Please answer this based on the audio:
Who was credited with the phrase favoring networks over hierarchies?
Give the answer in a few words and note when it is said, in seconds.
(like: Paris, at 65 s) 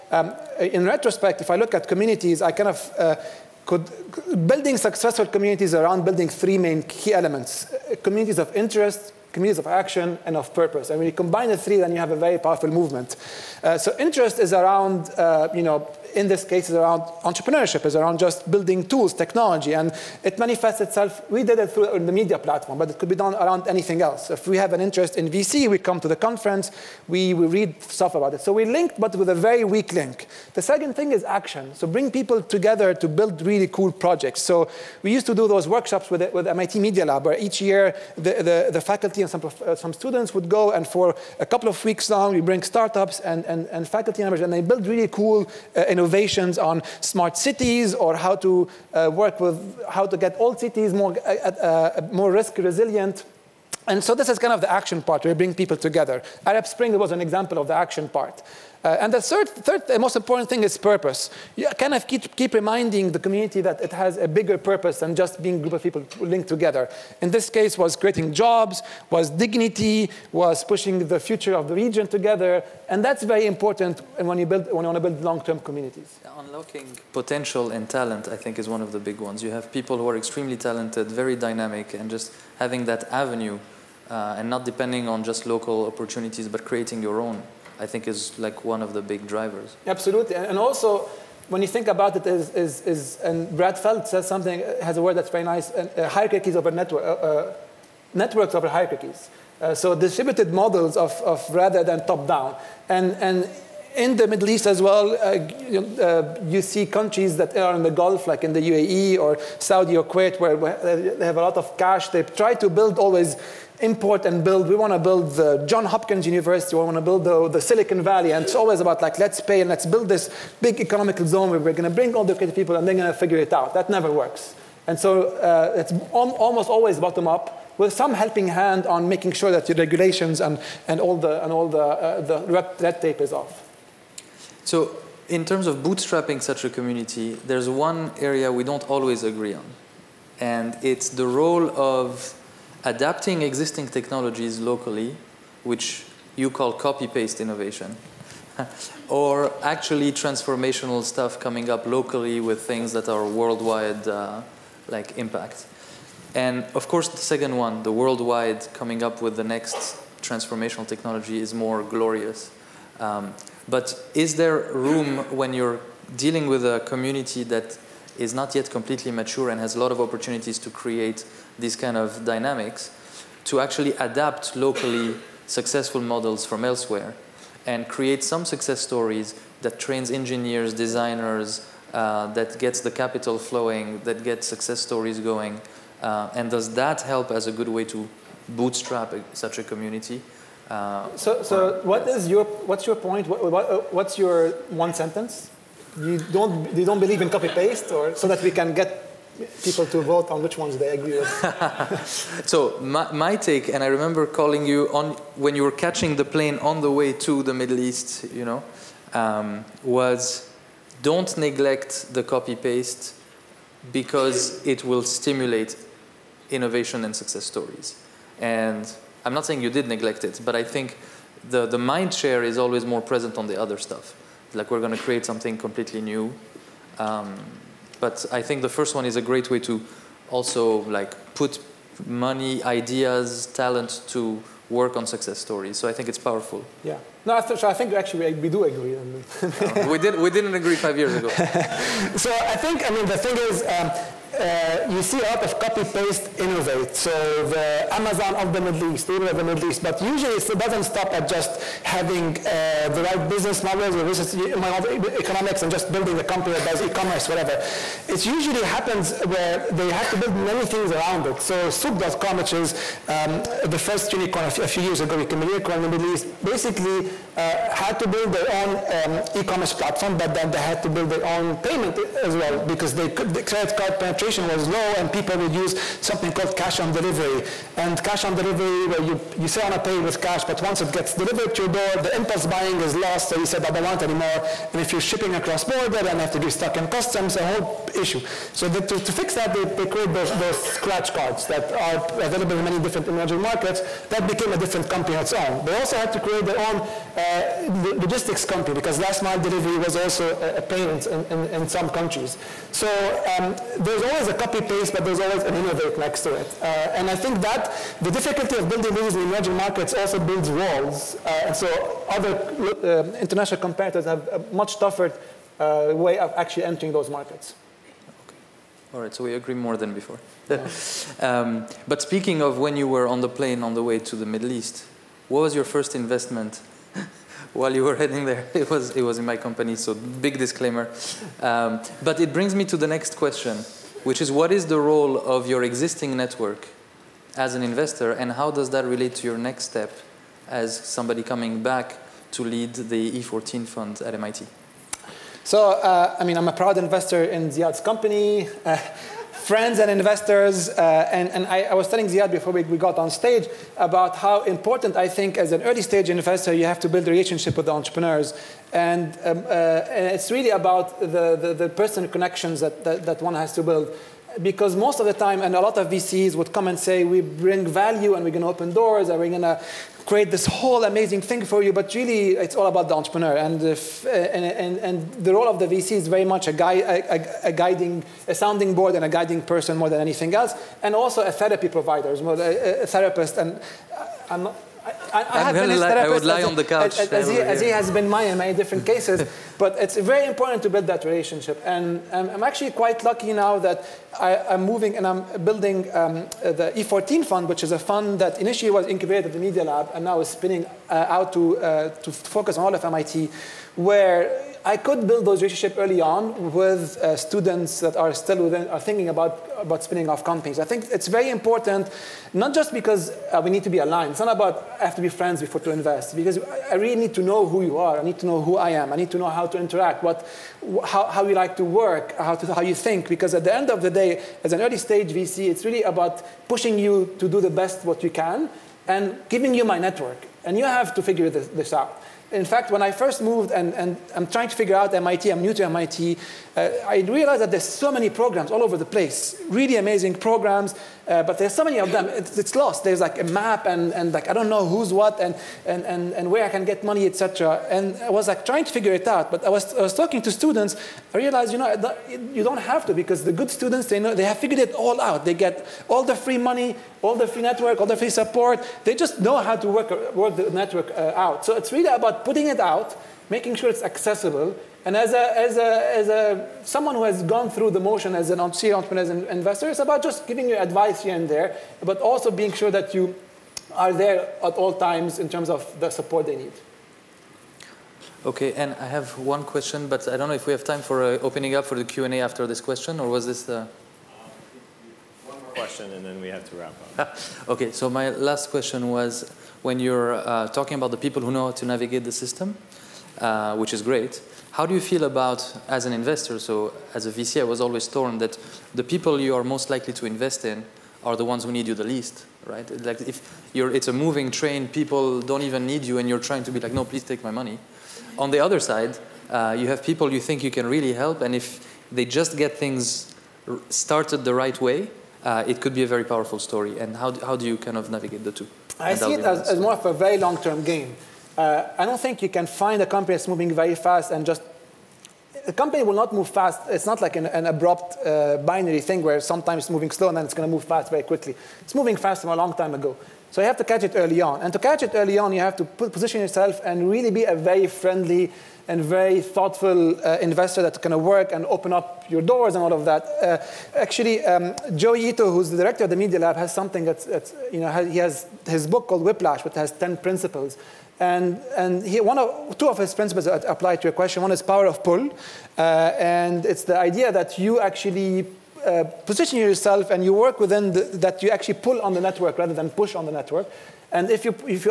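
Brad Feld, at 93 s.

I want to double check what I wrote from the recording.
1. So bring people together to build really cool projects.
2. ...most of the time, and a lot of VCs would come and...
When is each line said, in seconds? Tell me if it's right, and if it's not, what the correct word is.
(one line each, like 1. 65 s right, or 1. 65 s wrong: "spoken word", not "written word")
1. 31 s right
2. 364 s right.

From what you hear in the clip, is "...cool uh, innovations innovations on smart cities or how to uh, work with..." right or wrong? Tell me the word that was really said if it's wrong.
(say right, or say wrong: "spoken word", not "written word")
right.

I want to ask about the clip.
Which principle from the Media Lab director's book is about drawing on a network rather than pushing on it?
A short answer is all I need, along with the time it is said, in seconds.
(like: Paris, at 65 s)
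Power of pull, at 554 s.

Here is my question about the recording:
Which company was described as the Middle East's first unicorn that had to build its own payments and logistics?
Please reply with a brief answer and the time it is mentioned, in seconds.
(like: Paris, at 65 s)
Souq.com, at 261 s.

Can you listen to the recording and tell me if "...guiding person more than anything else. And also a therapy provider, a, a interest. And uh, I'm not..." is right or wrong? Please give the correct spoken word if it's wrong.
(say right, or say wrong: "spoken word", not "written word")
wrong: "therapist", not "interest".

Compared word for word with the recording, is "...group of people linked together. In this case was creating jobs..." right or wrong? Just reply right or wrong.
right.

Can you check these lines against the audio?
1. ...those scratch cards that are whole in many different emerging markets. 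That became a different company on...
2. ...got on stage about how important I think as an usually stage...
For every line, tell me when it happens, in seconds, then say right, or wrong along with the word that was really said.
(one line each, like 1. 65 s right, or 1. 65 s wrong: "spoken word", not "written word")
1. 290 s wrong: "available", not "whole"
2. 352 s wrong: "early", not "usually".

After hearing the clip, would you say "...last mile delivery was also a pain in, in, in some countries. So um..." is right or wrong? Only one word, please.
right.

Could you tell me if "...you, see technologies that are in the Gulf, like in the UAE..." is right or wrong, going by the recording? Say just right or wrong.
wrong.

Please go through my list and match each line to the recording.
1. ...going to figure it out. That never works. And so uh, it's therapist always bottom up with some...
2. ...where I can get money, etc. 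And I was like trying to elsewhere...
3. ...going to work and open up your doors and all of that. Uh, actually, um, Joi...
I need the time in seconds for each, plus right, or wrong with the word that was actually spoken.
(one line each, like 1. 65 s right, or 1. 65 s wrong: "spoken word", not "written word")
1. 122 s wrong: "almost", not "therapist"
2. 446 s wrong: "figure", not "elsewhere"
3. 540 s right.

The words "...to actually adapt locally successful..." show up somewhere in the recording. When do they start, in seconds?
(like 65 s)
173 s.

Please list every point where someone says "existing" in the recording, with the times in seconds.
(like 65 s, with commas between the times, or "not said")
143 s, 335 s.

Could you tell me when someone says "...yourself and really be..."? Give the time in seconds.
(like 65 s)
536 s.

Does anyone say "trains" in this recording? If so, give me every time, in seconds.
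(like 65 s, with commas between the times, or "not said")
179 s, 504 s.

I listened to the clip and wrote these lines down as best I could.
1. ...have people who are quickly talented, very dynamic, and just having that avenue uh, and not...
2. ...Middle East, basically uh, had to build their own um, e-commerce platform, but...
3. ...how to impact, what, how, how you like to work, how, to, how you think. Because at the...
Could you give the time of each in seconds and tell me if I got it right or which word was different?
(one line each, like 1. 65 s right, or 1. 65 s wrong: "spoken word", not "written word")
1. 79 s wrong: "extremely", not "quickly"
2. 265 s right
3. 419 s wrong: "interact", not "impact".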